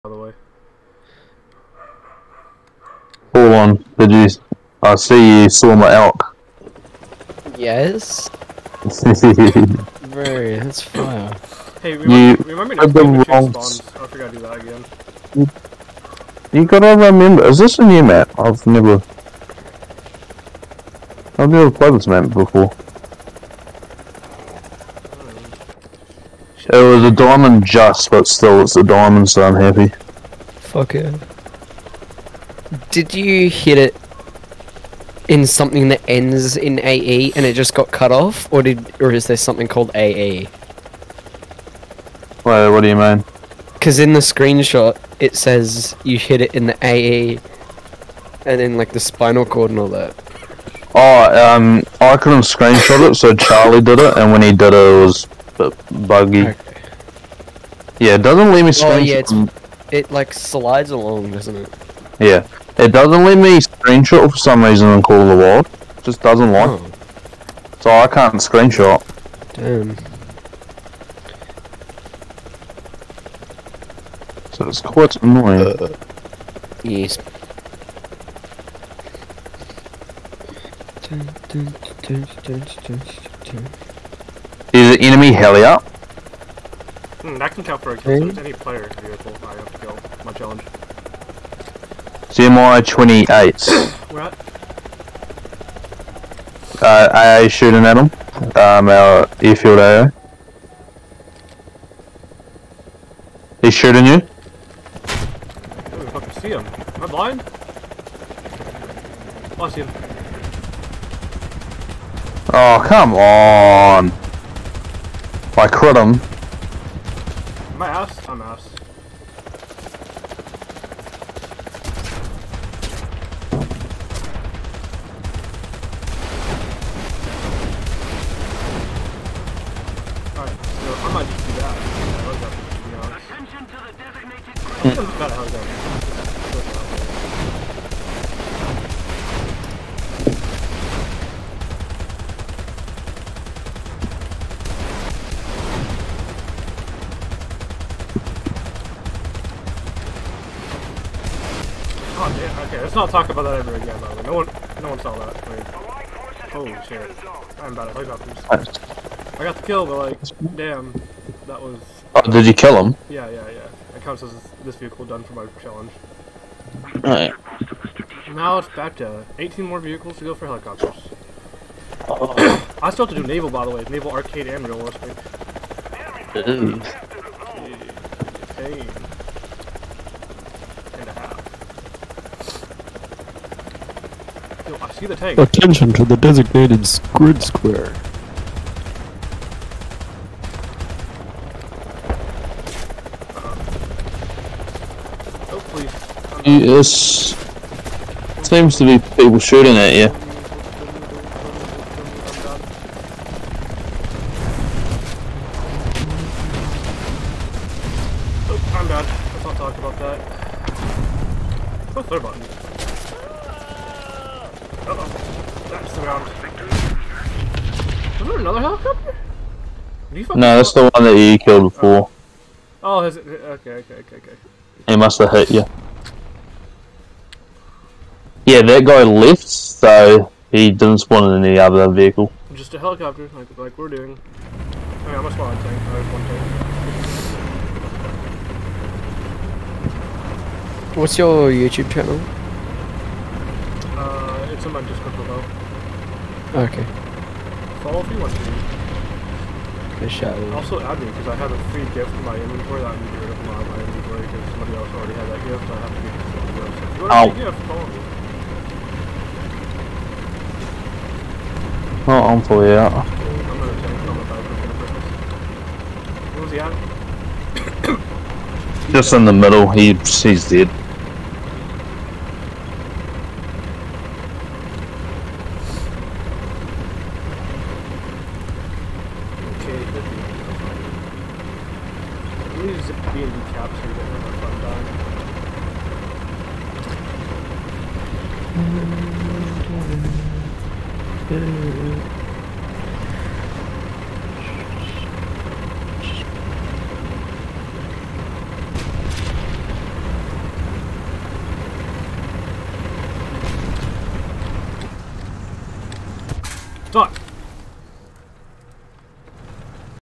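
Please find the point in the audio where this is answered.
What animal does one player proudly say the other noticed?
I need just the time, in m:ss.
0:05.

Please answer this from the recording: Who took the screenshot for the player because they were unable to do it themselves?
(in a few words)
Charlie.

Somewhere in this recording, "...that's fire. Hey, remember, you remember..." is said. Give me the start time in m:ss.
0:10.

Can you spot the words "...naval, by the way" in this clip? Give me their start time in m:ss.
2:53.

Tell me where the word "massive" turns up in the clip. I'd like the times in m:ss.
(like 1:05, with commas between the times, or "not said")
not said.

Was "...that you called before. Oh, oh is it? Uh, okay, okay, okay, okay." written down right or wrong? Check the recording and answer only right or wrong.
wrong.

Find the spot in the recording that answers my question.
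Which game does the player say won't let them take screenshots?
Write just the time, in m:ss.
1:05.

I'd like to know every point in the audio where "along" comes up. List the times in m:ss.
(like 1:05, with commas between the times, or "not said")
1:00.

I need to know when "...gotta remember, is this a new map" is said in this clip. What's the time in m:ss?
0:16.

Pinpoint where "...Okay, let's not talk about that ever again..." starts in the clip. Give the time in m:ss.
2:32.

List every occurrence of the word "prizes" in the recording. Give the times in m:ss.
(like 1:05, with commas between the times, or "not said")
not said.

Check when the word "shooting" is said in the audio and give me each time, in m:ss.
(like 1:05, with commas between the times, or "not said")
1:37, 1:43, 3:19.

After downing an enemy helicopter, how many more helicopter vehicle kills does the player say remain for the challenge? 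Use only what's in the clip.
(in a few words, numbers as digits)
18.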